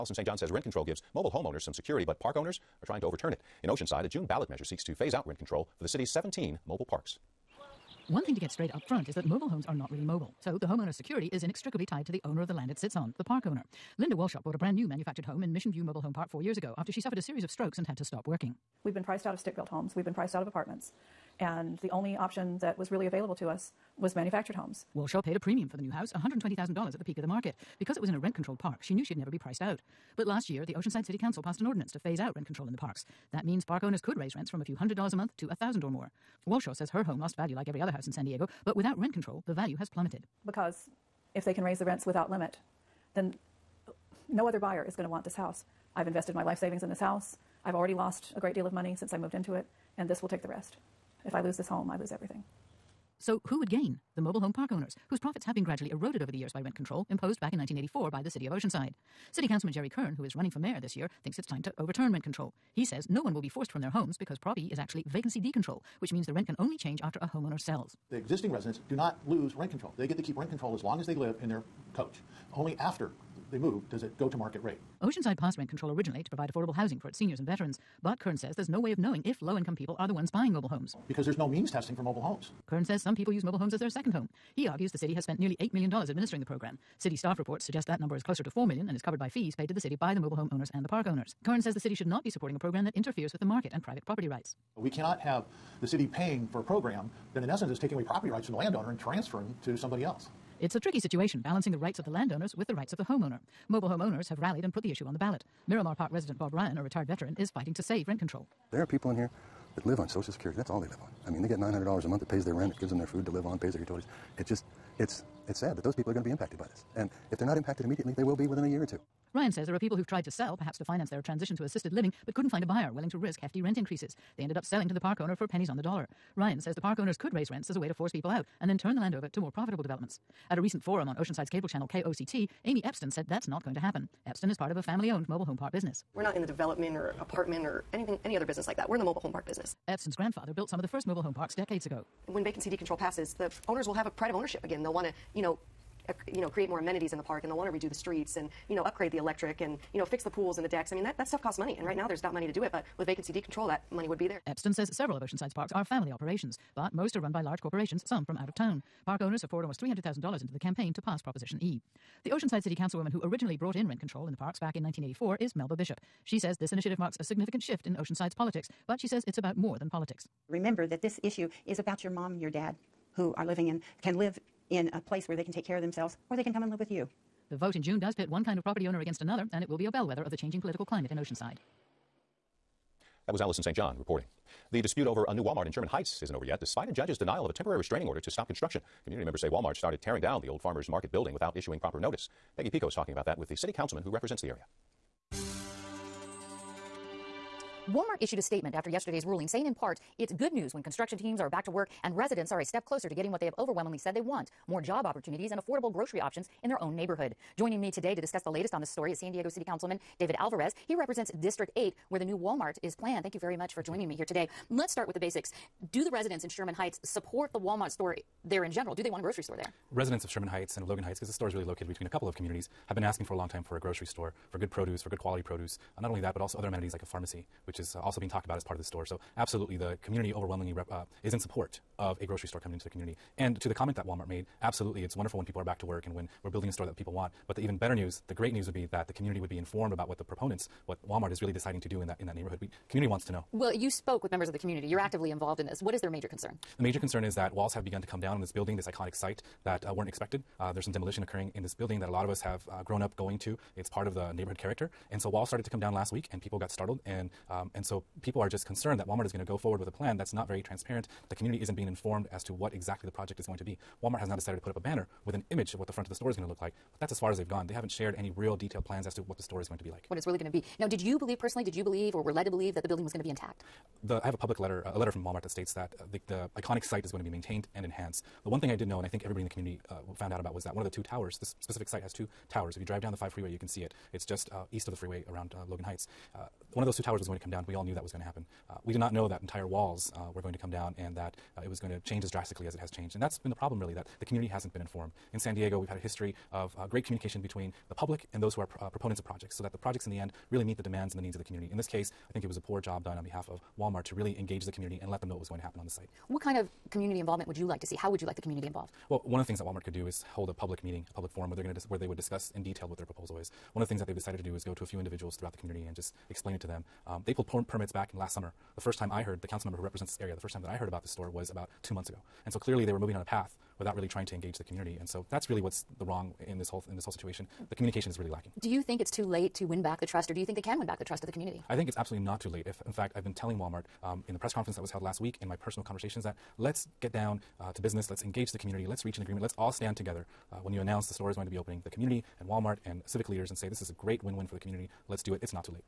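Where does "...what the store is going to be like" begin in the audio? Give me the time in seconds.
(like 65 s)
269 s.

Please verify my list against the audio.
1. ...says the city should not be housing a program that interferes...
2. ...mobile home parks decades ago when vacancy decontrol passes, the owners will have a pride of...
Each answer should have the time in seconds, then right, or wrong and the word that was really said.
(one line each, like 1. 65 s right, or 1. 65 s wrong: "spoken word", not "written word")
1. 91 s wrong: "supporting", not "housing"
2. 141 s right.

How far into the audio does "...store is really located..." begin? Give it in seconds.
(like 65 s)
221 s.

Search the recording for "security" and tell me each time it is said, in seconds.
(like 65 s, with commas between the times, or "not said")
1 s, 10 s, 110 s.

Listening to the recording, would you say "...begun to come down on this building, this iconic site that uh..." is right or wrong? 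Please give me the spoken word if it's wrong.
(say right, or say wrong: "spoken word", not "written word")
right.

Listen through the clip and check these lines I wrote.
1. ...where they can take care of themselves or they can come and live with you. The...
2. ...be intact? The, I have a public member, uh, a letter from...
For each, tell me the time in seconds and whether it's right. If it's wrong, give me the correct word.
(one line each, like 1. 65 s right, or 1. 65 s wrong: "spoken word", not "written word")
1. 175 s right
2. 273 s wrong: "letter", not "member".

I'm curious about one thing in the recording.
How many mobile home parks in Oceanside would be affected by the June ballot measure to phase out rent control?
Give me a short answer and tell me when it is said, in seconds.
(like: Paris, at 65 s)
17, at 6 s.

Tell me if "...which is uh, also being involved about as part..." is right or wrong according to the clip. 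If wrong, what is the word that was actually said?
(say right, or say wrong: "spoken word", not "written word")
wrong: "talked", not "involved".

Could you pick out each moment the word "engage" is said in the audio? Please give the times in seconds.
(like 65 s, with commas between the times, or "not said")
304 s, 324 s, 338 s.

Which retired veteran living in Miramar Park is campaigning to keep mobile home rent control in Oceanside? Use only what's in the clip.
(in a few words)
Bob Ryan.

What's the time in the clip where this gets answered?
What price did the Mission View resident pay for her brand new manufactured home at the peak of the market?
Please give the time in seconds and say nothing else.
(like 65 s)
26 s.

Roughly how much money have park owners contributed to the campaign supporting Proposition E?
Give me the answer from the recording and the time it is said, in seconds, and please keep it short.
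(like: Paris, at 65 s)
$300,000, at 159 s.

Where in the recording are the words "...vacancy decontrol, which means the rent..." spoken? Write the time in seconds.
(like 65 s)
65 s.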